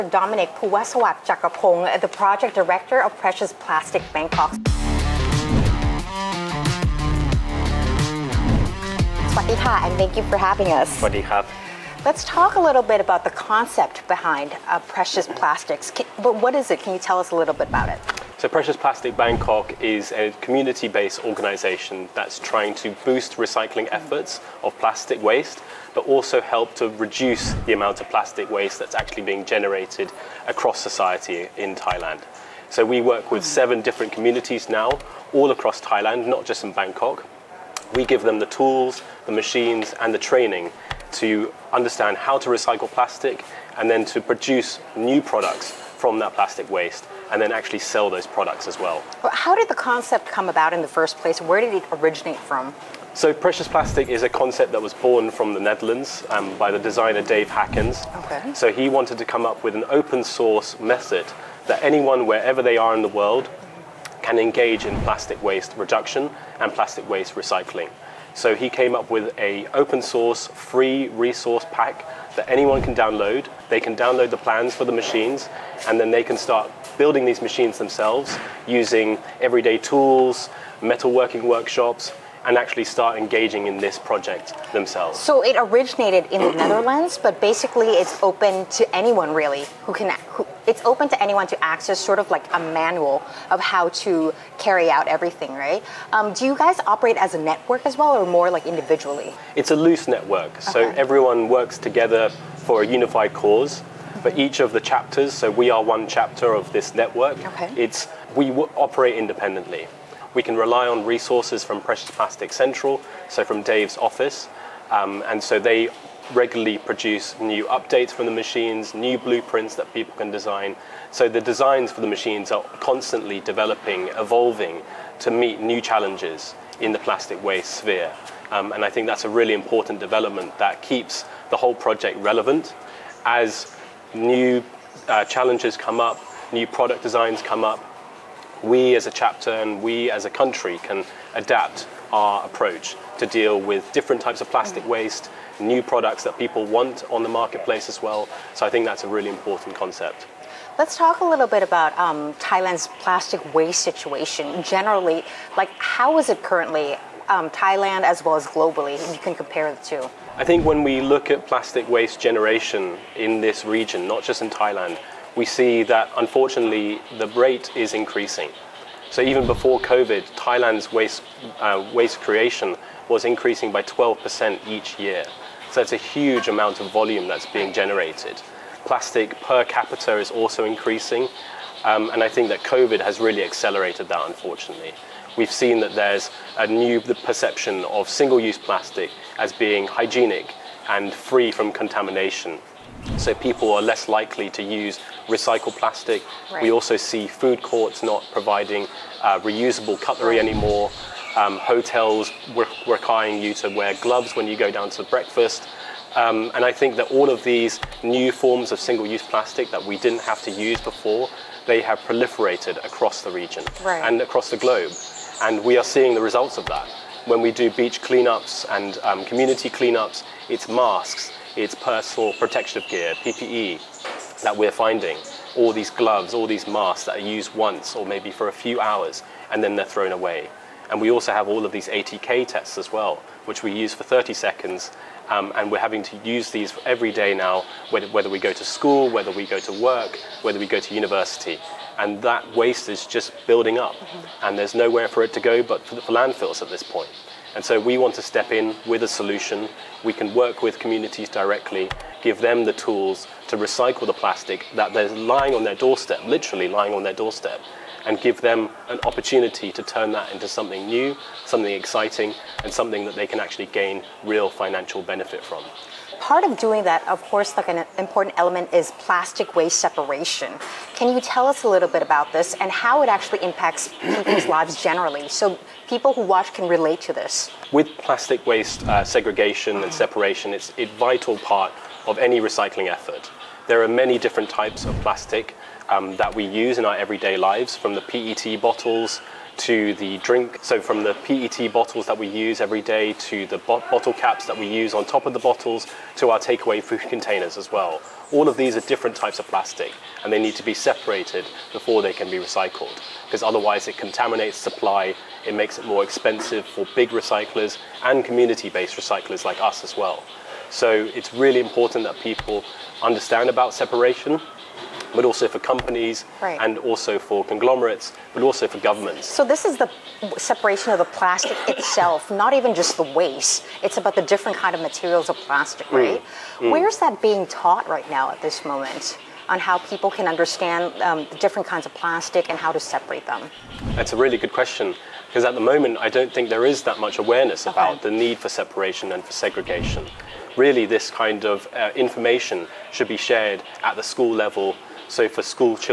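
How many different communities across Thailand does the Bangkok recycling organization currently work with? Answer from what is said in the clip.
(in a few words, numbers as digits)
7.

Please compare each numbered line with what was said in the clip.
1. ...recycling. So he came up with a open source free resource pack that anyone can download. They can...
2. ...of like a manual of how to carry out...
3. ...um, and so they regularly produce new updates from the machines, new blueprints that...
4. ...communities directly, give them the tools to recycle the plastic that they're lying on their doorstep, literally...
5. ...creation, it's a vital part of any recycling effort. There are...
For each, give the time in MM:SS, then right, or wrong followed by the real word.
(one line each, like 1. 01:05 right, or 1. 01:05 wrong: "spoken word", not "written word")
1. 01:07 right
2. 01:32 right
3. 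01:54 right
4. 04:10 right
5. 04:39 wrong: "separation", not "creation".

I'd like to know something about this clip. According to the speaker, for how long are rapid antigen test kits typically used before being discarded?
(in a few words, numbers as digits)
30 seconds.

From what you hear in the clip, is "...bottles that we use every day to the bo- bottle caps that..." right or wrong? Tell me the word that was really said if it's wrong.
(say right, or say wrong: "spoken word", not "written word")
right.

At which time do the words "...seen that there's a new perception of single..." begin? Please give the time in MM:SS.
03:05.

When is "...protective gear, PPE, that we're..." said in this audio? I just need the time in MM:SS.
03:42.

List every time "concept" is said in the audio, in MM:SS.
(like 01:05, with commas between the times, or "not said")
00:13, 00:49, 00:54, 02:29.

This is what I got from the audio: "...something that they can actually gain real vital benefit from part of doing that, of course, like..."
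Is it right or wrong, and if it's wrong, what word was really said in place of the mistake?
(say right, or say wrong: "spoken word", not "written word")
wrong: "financial", not "vital".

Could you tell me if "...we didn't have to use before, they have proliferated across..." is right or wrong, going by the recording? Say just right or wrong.
right.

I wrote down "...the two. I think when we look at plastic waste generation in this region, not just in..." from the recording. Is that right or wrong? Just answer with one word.
right.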